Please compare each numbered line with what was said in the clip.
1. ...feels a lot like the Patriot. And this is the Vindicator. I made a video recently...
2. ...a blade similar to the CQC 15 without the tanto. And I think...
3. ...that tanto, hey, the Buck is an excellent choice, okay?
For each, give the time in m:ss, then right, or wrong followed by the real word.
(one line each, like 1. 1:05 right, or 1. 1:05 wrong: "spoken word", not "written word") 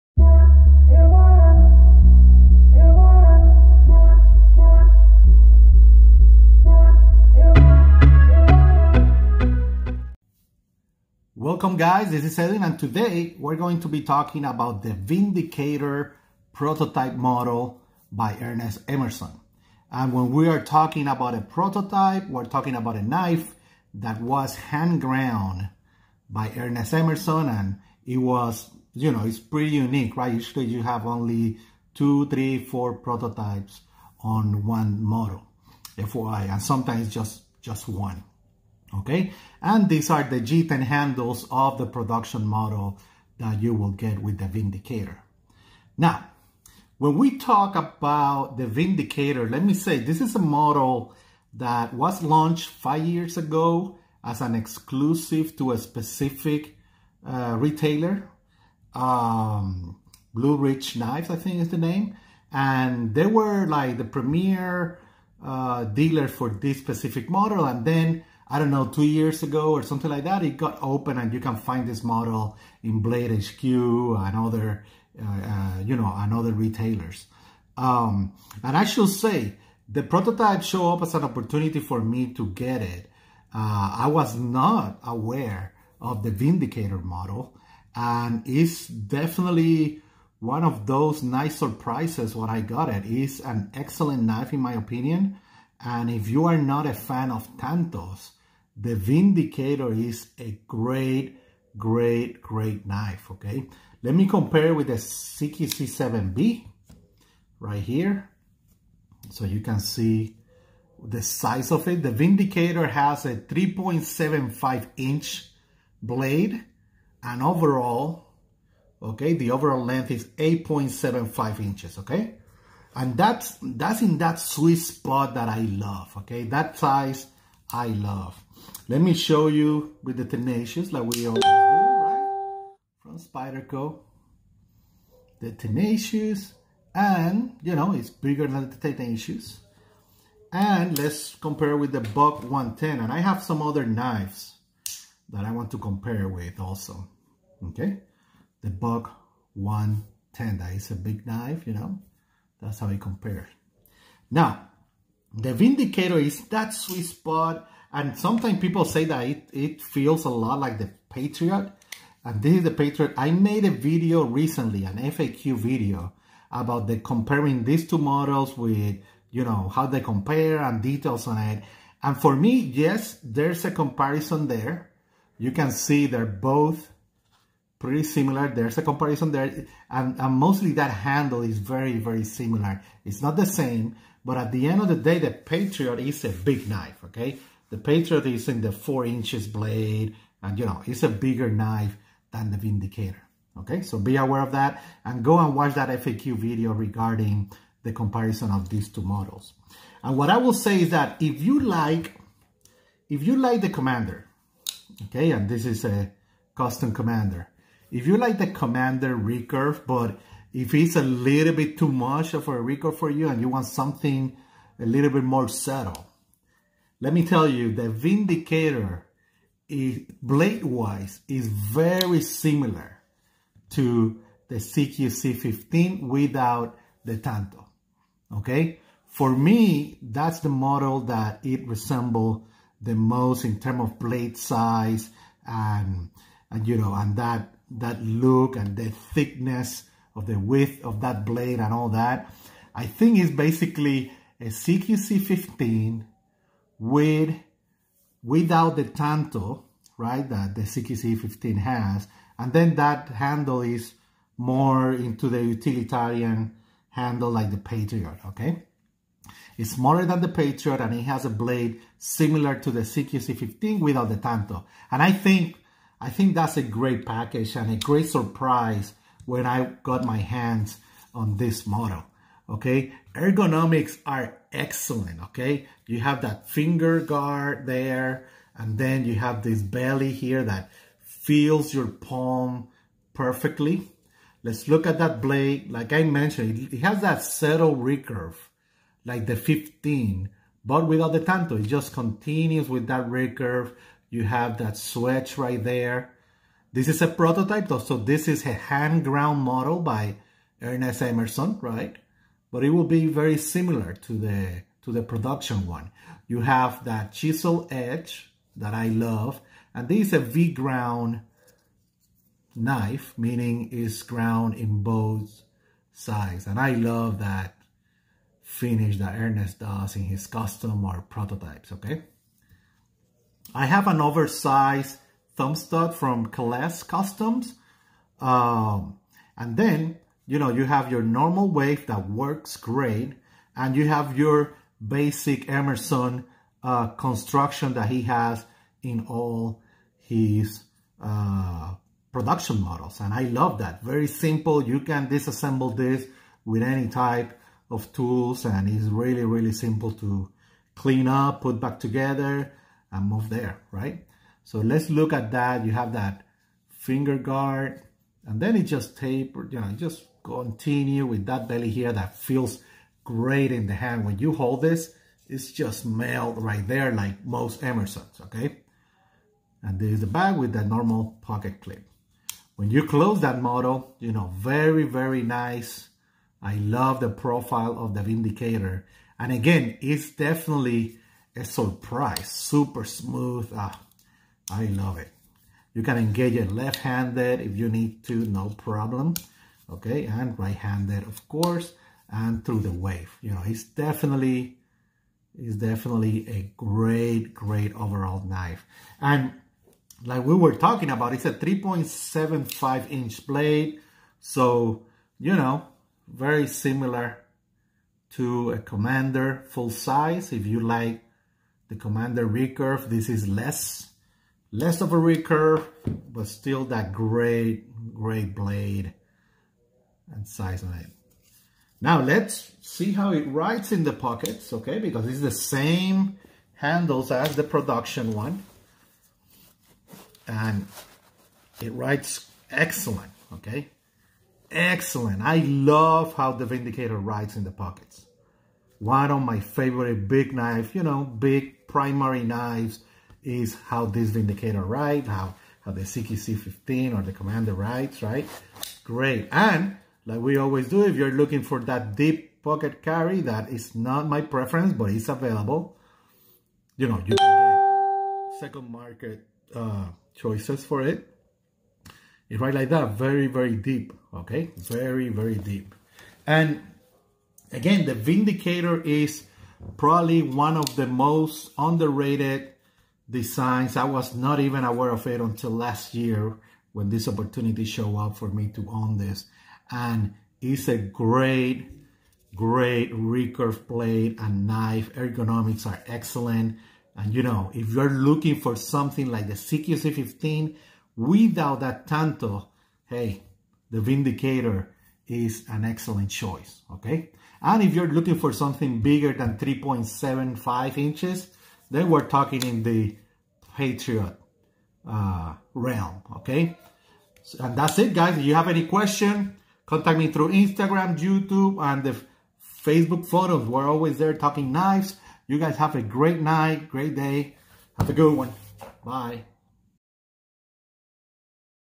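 1. 2:39 wrong: "Patriot", not "Vindicator"
2. 4:21 right
3. 8:11 wrong: "Vindicator", not "Buck".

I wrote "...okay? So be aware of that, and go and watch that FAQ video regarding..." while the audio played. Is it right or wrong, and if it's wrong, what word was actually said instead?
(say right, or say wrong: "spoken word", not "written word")
right.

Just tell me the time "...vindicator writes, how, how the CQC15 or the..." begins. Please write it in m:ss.
7:24.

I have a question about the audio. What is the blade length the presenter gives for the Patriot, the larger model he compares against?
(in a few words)
4 inches.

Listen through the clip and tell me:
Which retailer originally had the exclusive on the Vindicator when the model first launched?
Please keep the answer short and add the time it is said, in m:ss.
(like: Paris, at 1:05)
Blue Ridge Knives, at 1:00.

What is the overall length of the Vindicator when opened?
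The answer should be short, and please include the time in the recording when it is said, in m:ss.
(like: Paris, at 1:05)
8.75 inches, at 2:00.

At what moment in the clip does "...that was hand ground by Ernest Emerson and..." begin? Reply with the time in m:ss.
0:23.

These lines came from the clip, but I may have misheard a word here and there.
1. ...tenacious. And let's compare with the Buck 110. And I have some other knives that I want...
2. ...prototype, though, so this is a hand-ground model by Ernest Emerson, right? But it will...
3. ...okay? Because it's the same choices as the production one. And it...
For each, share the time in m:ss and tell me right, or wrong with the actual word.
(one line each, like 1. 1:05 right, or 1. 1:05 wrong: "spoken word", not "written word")
1. 2:18 right
2. 4:57 right
3. 7:04 wrong: "handles", not "choices".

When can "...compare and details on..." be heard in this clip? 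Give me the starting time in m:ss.
2:50.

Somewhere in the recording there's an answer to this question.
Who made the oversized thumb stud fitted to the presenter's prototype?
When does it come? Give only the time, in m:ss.
5:26.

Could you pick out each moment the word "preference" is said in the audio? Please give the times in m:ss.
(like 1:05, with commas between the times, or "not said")
7:34.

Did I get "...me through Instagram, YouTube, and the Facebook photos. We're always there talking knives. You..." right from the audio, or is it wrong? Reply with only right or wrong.
right.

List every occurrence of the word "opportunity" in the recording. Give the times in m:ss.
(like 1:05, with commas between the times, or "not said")
1:21, 7:57.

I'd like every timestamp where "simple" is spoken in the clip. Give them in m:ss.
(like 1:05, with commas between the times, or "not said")
5:44, 5:49.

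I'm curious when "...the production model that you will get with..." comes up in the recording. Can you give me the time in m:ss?
0:41.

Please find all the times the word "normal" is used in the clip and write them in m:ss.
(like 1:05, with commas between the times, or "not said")
5:31, 6:10.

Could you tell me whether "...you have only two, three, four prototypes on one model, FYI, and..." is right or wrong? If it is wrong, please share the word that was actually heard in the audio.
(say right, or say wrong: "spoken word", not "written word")
right.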